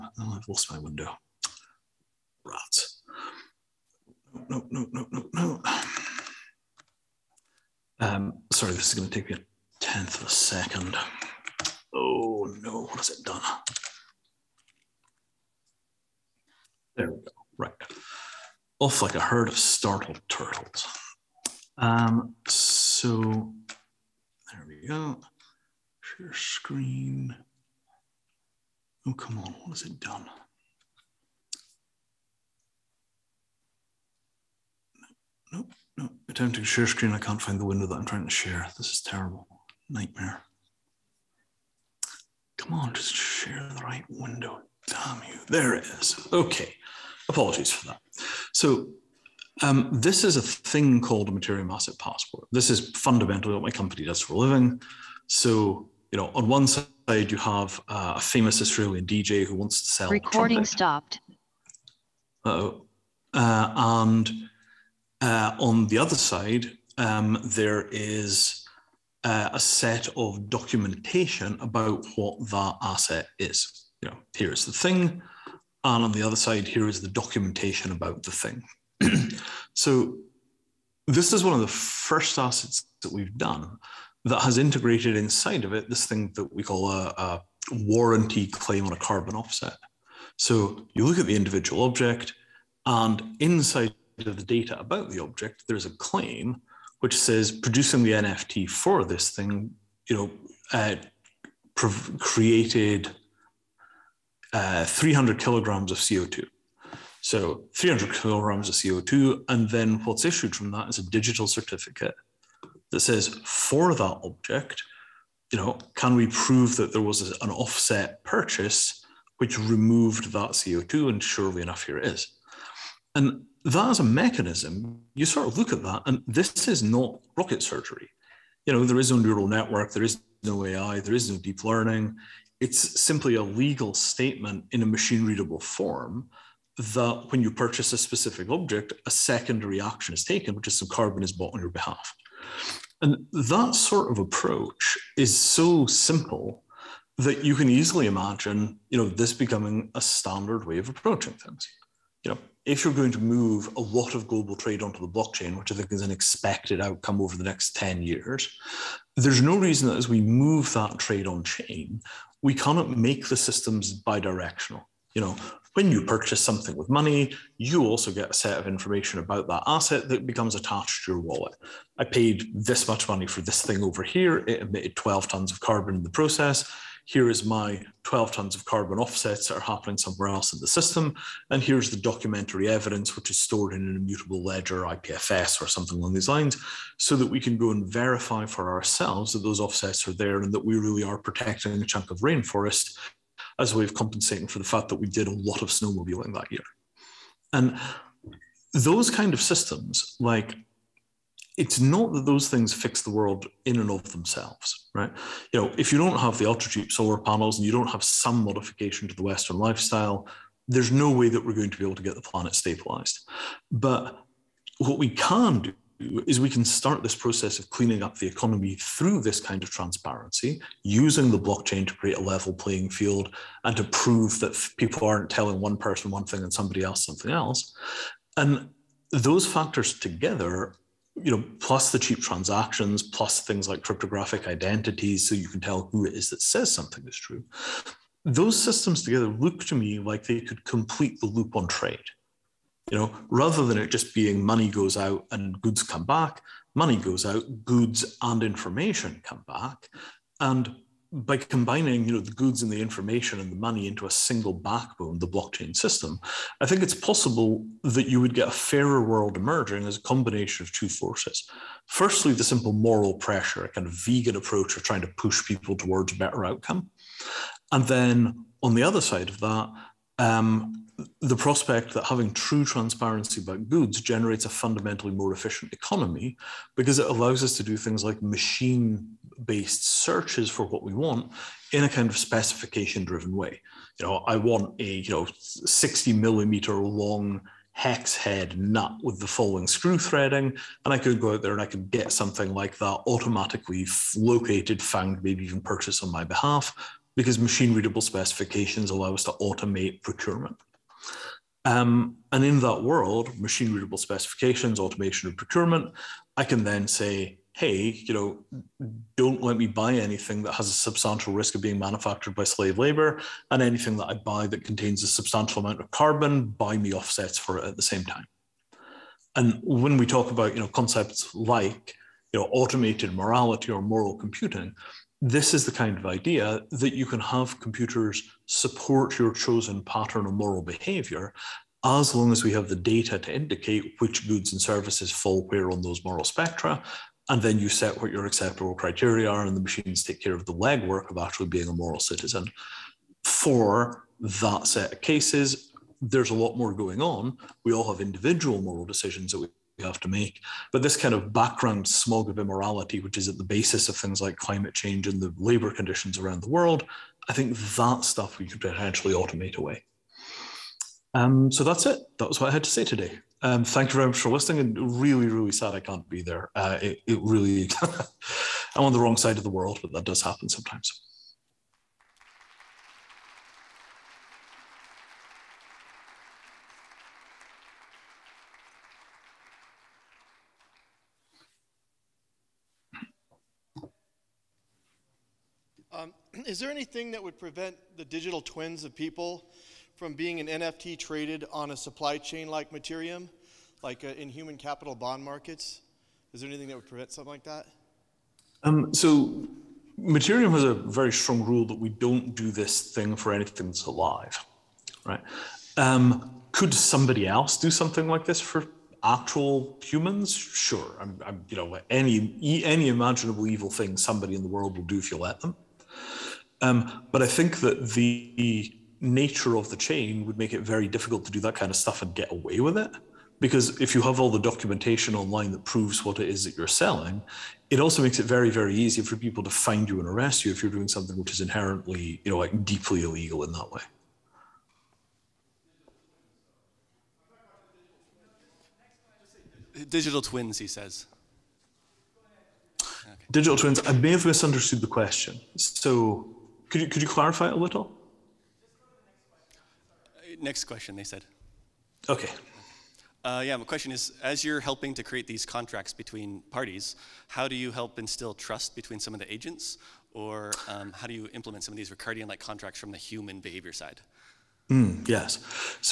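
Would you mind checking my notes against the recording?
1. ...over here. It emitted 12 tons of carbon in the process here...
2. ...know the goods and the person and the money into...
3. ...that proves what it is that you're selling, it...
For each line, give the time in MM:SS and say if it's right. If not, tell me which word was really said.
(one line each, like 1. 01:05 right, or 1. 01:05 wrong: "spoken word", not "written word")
1. 02:53 right
2. 04:12 wrong: "information", not "person"
3. 07:05 right.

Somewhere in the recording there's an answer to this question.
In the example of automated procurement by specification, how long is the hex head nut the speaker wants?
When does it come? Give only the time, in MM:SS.
04:45.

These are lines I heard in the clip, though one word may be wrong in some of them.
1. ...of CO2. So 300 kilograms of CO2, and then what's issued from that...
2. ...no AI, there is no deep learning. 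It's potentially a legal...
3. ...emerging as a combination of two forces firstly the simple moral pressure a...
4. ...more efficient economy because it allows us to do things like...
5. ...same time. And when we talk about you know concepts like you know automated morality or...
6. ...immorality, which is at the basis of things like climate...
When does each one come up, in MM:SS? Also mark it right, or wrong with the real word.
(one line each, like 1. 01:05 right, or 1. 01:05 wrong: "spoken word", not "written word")
1. 01:45 right
2. 02:10 wrong: "simply", not "potentially"
3. 04:19 right
4. 04:35 right
5. 05:17 right
6. 05:52 right.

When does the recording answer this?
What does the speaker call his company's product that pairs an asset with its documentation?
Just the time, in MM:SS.
00:51.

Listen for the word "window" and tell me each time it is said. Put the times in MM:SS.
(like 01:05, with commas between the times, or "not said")
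00:00, 00:37, 00:44.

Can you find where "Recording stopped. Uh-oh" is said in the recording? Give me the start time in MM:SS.
01:00.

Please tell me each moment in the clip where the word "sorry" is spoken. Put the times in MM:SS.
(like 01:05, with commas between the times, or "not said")
00:08.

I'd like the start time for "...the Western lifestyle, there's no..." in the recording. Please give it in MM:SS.
03:29.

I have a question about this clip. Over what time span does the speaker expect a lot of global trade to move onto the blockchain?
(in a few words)
10 years.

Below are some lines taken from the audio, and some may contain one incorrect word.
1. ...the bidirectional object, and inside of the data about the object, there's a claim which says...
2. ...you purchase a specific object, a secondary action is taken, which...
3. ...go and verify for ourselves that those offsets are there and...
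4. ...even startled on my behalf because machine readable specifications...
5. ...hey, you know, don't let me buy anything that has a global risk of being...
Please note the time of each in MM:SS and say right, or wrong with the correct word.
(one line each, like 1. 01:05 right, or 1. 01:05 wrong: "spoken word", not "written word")
1. 01:31 wrong: "individual", not "bidirectional"
2. 02:17 right
3. 03:07 right
4. 04:55 wrong: "purchased", not "startled"
5. 05:07 wrong: "substantial", not "global".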